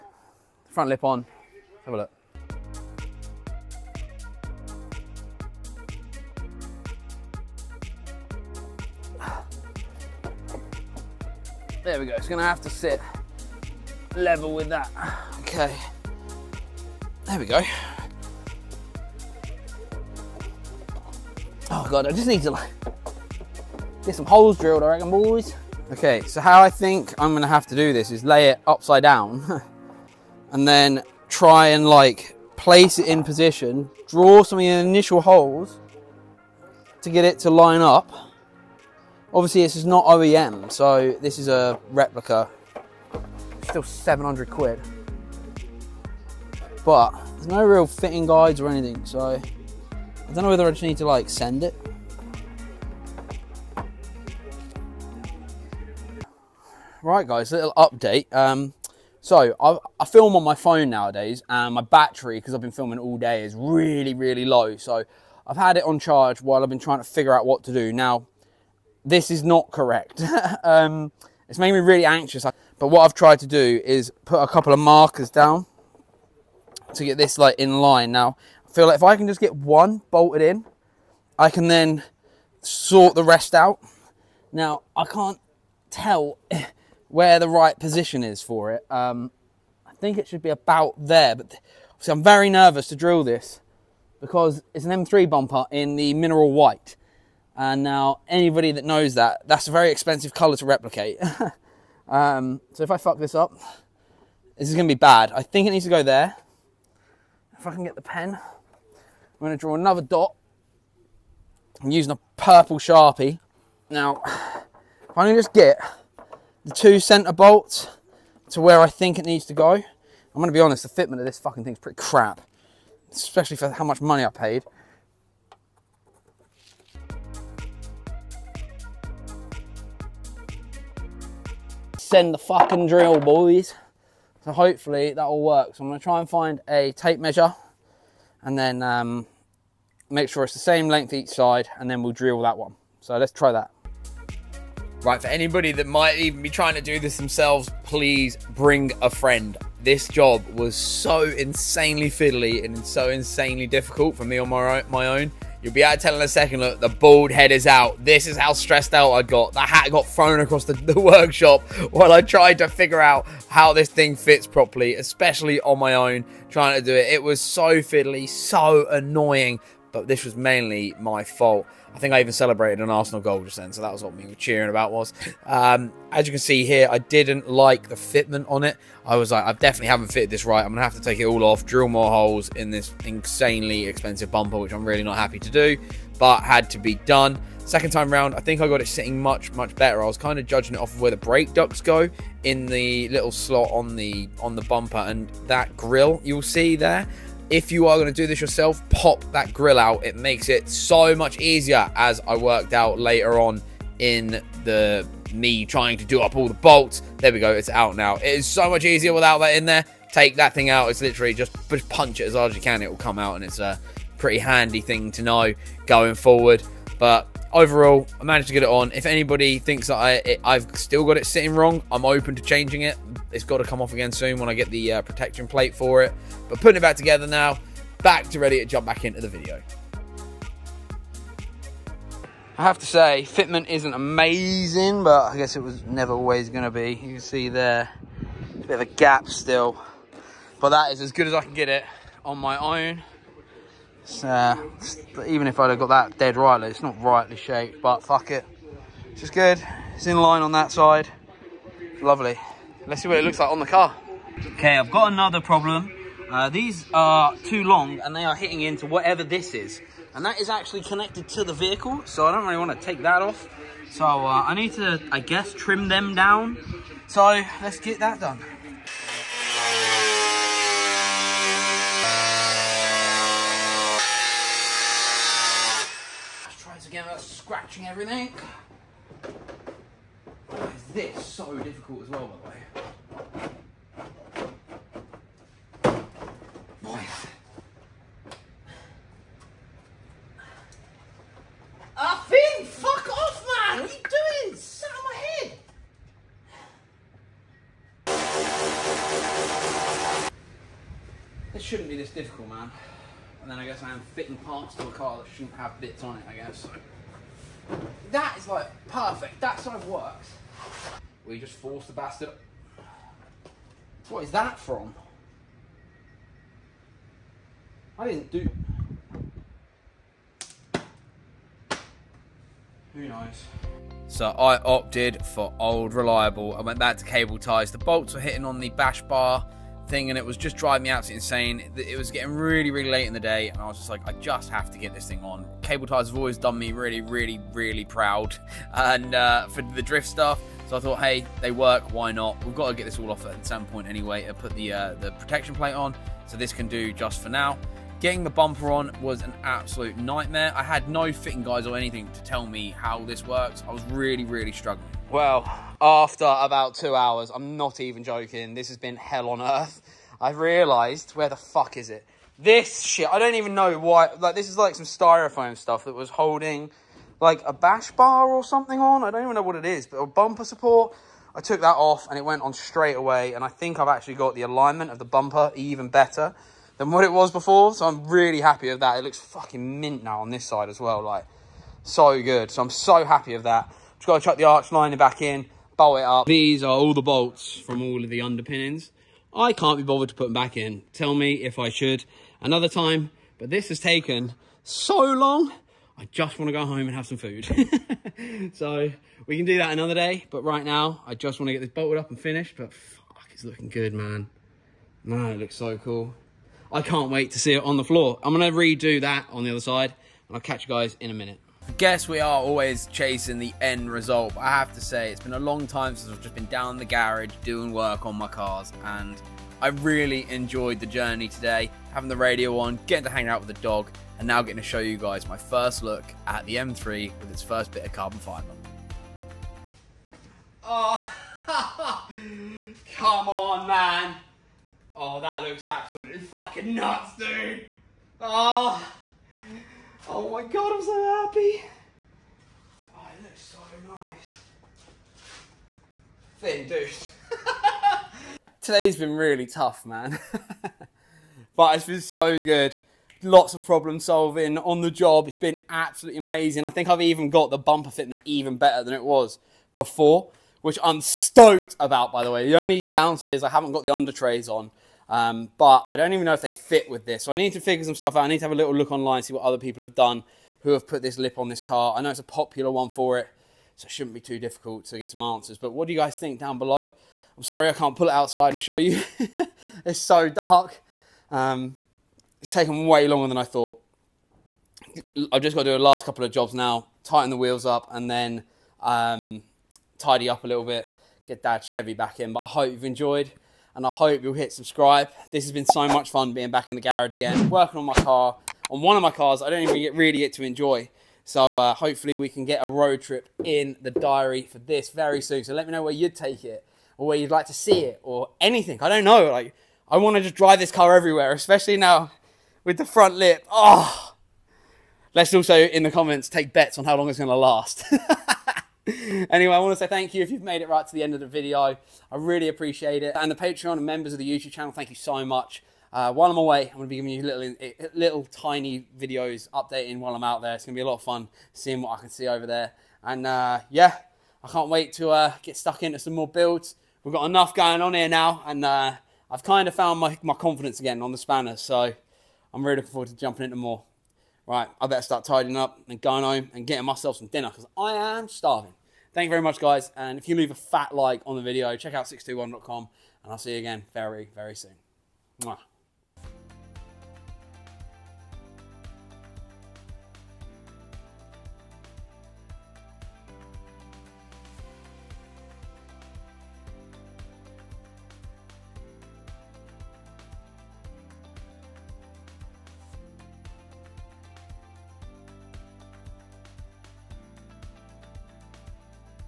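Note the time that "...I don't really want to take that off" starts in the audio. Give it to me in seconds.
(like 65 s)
262 s.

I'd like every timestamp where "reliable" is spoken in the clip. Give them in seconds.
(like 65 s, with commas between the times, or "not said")
325 s.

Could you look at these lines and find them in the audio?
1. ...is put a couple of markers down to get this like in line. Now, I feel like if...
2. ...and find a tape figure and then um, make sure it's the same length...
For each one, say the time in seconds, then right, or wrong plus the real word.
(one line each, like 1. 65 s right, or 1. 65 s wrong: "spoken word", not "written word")
1. 73 s right
2. 136 s wrong: "measure", not "figure".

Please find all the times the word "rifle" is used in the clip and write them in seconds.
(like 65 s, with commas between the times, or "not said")
not said.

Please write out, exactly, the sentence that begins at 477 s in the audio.
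I'm sorry I can't pull it outside and show you.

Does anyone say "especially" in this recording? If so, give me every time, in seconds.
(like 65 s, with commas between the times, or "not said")
123 s, 164 s, 511 s.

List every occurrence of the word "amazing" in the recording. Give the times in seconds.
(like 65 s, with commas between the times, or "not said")
233 s, 456 s.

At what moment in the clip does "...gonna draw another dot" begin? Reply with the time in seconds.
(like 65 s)
109 s.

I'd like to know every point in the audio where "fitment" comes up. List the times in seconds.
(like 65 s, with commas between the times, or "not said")
121 s, 177 s, 233 s, 457 s.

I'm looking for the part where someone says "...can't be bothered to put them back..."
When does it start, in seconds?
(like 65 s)
389 s.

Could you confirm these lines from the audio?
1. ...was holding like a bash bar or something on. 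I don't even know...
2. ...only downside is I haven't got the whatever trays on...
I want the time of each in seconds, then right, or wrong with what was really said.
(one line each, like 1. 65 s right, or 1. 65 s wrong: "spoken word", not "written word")
1. 365 s right
2. 462 s wrong: "under", not "whatever".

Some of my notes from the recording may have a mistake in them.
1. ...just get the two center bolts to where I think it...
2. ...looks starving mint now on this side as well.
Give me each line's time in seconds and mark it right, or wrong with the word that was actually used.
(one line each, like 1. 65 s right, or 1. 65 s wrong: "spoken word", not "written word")
1. 115 s right
2. 379 s wrong: "fucking", not "starving".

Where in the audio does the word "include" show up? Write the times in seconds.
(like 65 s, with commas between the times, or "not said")
not said.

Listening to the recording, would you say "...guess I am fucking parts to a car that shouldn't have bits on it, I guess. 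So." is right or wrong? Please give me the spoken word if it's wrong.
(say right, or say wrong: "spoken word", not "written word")
wrong: "fitting", not "fucking".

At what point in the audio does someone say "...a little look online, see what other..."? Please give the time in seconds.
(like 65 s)
468 s.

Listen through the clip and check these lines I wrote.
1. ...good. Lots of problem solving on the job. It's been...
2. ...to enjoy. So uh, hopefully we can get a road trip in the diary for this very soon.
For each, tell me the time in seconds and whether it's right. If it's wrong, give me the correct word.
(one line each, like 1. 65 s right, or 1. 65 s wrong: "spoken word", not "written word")
1. 452 s right
2. 500 s right.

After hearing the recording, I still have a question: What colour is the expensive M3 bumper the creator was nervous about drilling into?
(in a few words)
mineral white.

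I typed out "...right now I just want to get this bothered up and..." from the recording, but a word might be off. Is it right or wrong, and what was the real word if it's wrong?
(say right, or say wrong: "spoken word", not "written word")
wrong: "bolted", not "bothered".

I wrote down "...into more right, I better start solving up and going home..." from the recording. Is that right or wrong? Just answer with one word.
wrong.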